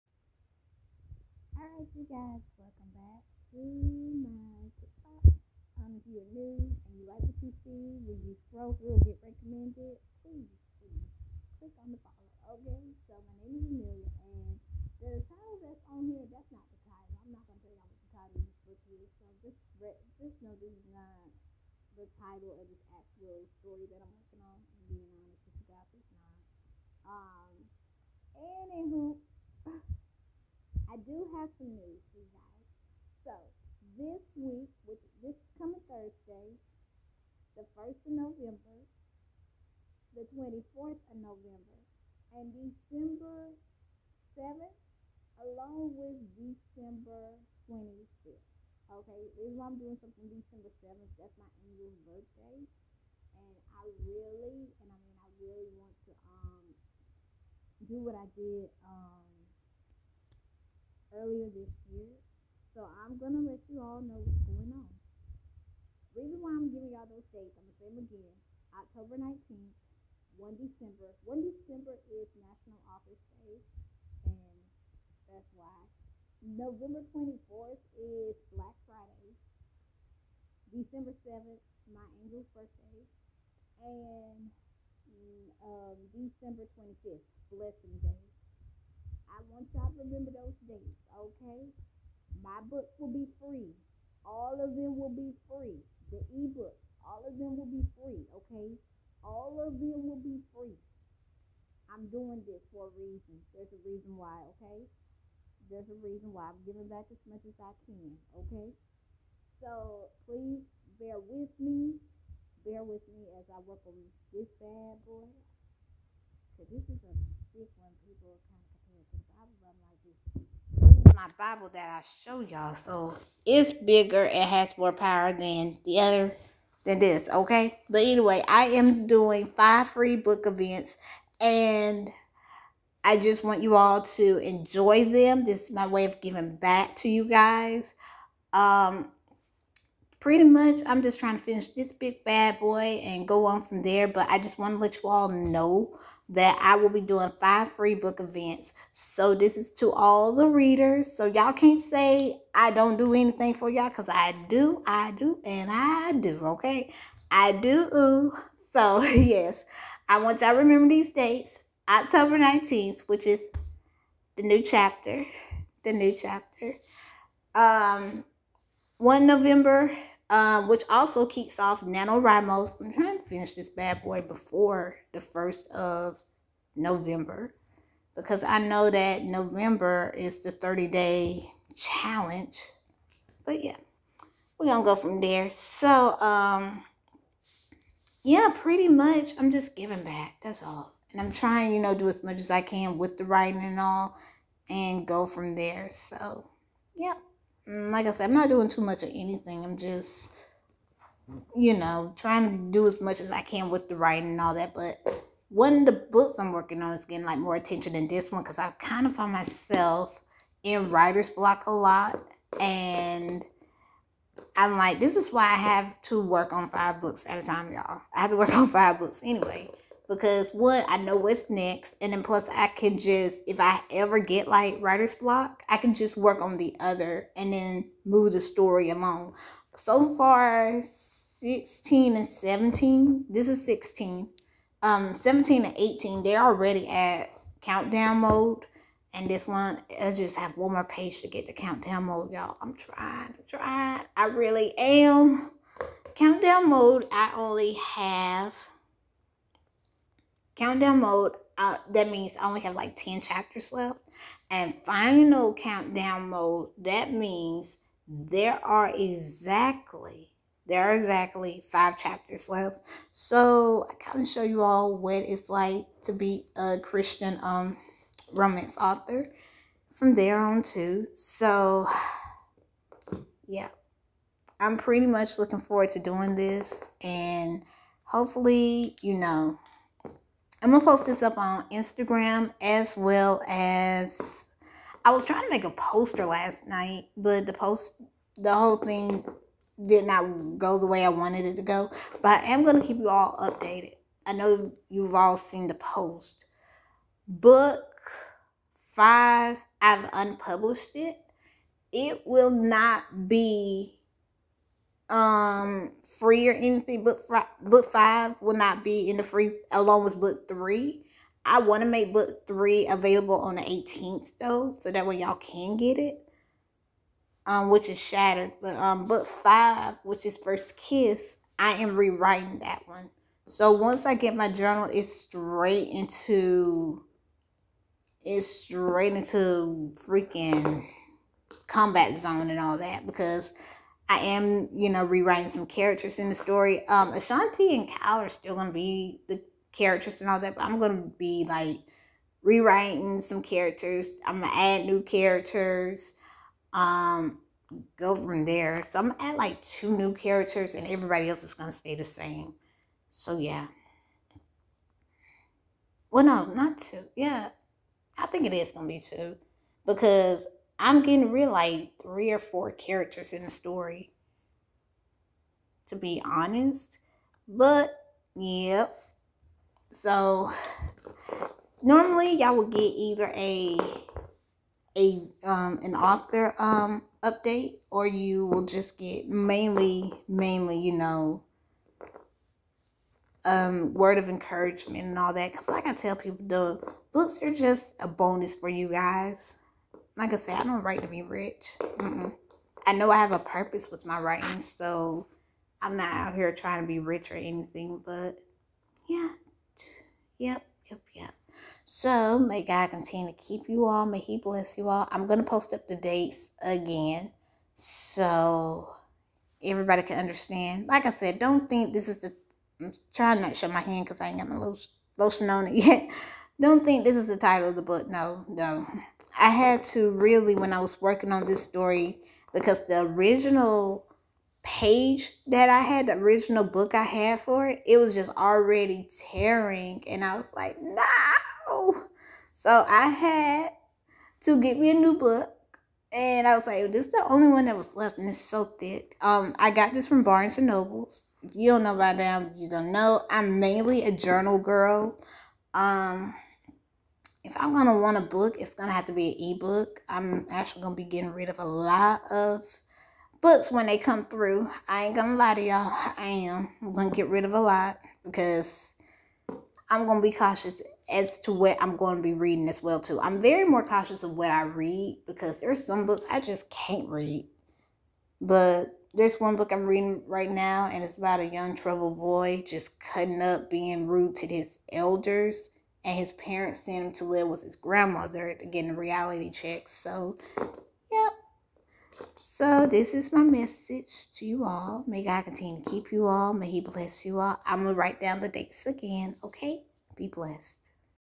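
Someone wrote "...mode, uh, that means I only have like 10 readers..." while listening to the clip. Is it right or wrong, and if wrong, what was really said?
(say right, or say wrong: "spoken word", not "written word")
wrong: "chapters", not "readers".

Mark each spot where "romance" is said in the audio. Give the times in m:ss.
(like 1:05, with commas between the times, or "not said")
4:28.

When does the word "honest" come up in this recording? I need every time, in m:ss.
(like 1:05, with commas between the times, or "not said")
0:25, 6:06.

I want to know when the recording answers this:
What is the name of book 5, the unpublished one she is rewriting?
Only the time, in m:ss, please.
5:20.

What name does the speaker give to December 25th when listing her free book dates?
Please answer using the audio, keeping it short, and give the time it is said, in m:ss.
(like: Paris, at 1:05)
Blessing Day, at 1:27.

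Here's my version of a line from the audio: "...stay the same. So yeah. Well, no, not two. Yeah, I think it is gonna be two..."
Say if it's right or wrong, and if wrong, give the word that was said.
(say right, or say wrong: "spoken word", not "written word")
right.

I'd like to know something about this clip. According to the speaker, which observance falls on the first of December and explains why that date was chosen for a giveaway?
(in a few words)
National Author's Day.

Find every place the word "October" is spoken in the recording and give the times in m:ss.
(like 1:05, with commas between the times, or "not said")
1:08, 2:41.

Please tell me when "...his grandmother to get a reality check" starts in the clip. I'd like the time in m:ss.
7:57.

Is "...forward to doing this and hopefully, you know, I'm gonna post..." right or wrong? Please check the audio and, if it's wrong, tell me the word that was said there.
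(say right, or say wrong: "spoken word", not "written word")
right.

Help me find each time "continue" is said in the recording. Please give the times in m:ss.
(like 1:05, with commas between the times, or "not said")
6:42, 8:05.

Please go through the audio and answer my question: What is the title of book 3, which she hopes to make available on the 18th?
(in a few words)
Shattered.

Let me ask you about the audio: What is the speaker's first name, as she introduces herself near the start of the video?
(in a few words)
Amelia.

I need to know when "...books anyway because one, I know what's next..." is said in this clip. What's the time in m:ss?
3:38.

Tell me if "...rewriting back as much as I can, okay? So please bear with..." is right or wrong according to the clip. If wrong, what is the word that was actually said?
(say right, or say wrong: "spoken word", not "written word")
wrong: "giving", not "rewriting".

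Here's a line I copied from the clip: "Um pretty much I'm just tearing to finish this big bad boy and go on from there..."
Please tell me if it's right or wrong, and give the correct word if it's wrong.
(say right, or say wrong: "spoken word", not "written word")
wrong: "trying", not "tearing".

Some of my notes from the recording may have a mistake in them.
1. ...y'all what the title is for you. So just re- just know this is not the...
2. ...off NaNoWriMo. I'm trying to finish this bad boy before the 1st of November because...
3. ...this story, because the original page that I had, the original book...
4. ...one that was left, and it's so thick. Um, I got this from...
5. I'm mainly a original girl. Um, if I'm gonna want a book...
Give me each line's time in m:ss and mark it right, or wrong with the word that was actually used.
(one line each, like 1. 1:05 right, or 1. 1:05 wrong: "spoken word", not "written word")
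1. 0:17 right
2. 2:51 right
3. 7:01 right
4. 7:17 right
5. 7:23 wrong: "journal", not "original".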